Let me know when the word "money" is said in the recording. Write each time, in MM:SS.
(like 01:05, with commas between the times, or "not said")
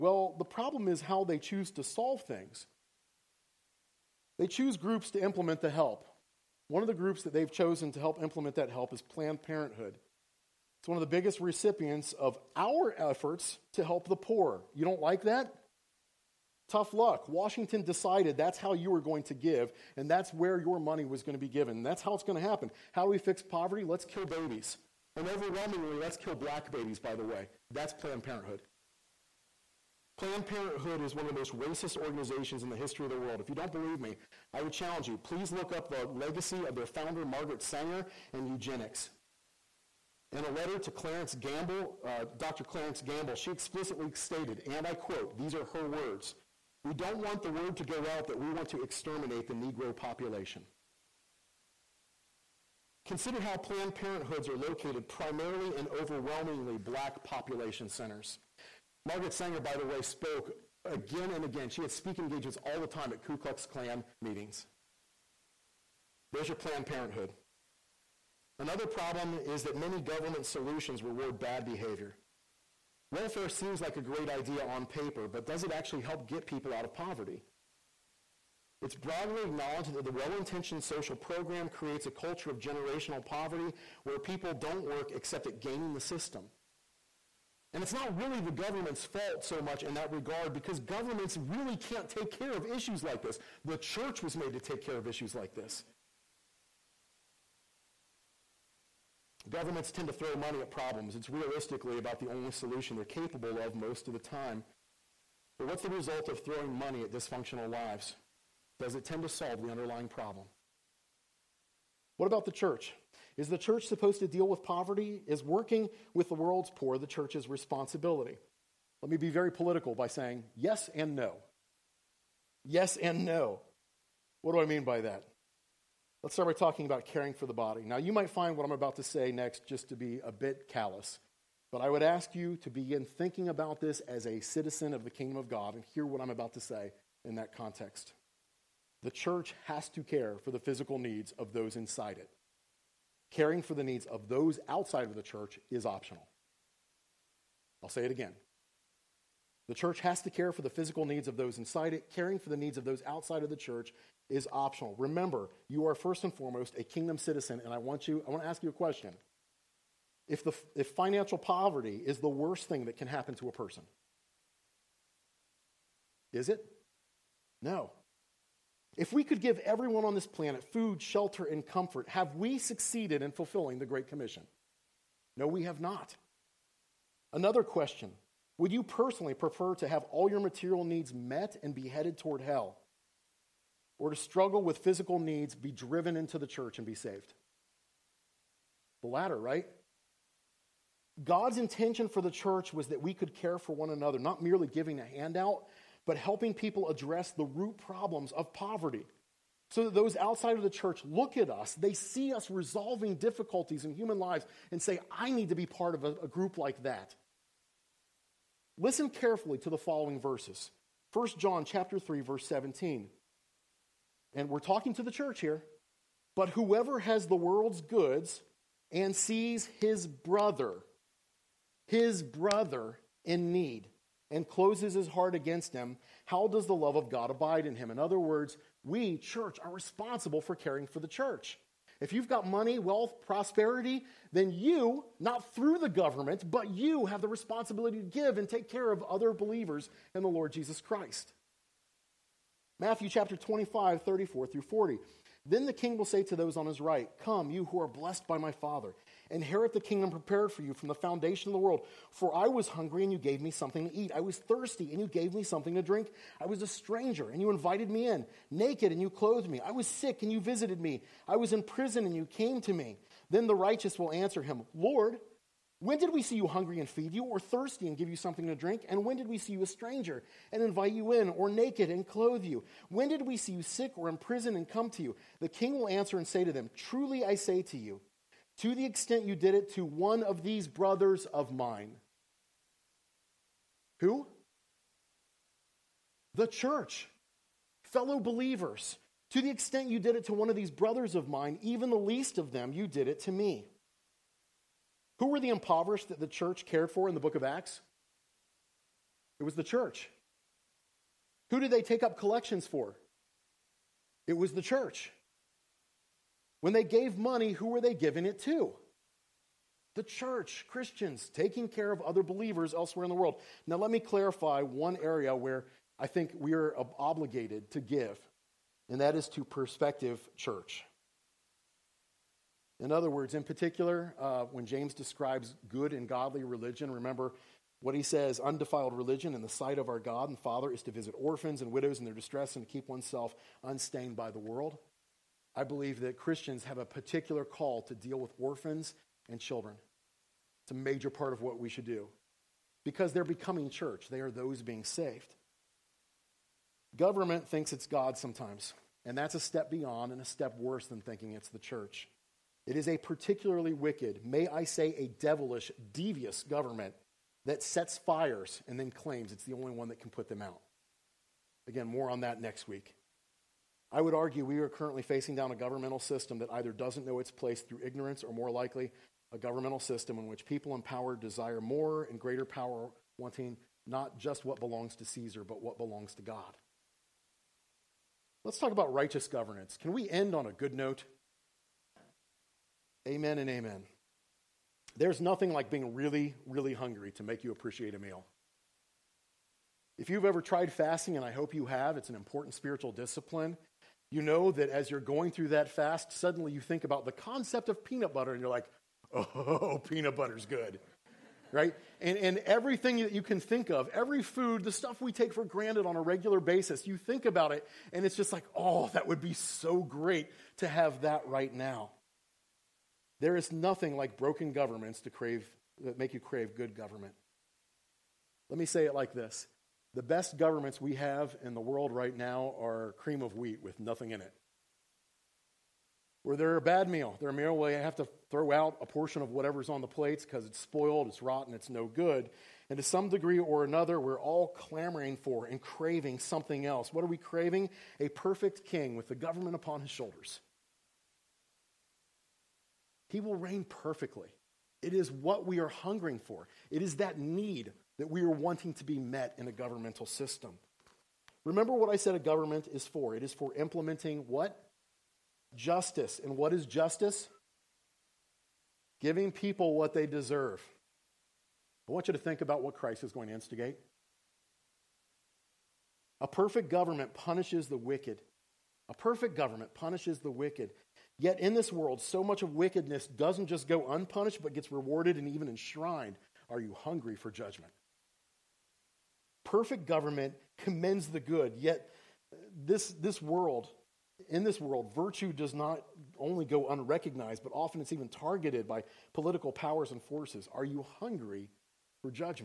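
00:20, 01:40, 01:46, 03:52, 05:07.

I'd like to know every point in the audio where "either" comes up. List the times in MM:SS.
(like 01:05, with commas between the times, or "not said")
06:06.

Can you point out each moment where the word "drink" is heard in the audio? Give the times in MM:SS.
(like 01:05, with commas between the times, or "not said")
04:15, 04:28.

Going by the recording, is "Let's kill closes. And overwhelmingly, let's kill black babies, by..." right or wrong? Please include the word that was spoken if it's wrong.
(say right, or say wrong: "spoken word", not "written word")
wrong: "babies", not "closes".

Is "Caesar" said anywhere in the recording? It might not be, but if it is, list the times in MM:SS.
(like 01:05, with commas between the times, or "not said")
06:15.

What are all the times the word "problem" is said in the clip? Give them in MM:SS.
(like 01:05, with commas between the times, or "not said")
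00:00, 01:08, 01:40, 01:50, 03:17.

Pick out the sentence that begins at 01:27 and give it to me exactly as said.
And it's not really the government's fault so much in that regard because governments really can't take care of issues like this.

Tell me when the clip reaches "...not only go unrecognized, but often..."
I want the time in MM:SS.
08:05.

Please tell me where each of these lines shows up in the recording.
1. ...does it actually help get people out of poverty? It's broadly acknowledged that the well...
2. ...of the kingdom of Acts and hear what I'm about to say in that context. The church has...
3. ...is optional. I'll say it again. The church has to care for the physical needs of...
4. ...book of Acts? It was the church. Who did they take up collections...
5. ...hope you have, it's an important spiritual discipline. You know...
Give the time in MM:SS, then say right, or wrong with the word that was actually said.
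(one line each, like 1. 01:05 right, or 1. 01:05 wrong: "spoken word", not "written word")
1. 01:15 right
2. 02:14 wrong: "God", not "Acts"
3. 02:25 right
4. 04:57 right
5. 06:31 right.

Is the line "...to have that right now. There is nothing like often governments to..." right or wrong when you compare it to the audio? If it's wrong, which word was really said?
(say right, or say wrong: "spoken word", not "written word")
wrong: "broken", not "often".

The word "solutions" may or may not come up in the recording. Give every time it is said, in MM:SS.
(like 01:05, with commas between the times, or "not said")
01:10, 01:42.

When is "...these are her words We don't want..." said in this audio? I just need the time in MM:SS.
00:45.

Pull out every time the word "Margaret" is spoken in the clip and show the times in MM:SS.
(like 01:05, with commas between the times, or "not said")
00:37, 00:59.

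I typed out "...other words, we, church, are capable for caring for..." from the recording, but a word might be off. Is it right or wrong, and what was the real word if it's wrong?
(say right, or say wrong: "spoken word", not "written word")
wrong: "responsible", not "capable".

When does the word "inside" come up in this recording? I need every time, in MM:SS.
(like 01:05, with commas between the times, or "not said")
02:21, 02:31.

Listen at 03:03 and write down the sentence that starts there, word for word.
Or to struggle with physical needs, be driven into the church, and be saved?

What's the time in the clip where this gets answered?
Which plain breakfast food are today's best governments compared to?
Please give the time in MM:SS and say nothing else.
07:02.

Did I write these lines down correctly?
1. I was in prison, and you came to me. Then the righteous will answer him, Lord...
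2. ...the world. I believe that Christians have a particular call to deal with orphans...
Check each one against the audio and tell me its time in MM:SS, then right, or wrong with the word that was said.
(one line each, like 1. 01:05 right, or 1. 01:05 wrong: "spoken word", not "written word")
1. 04:21 right
2. 05:34 right.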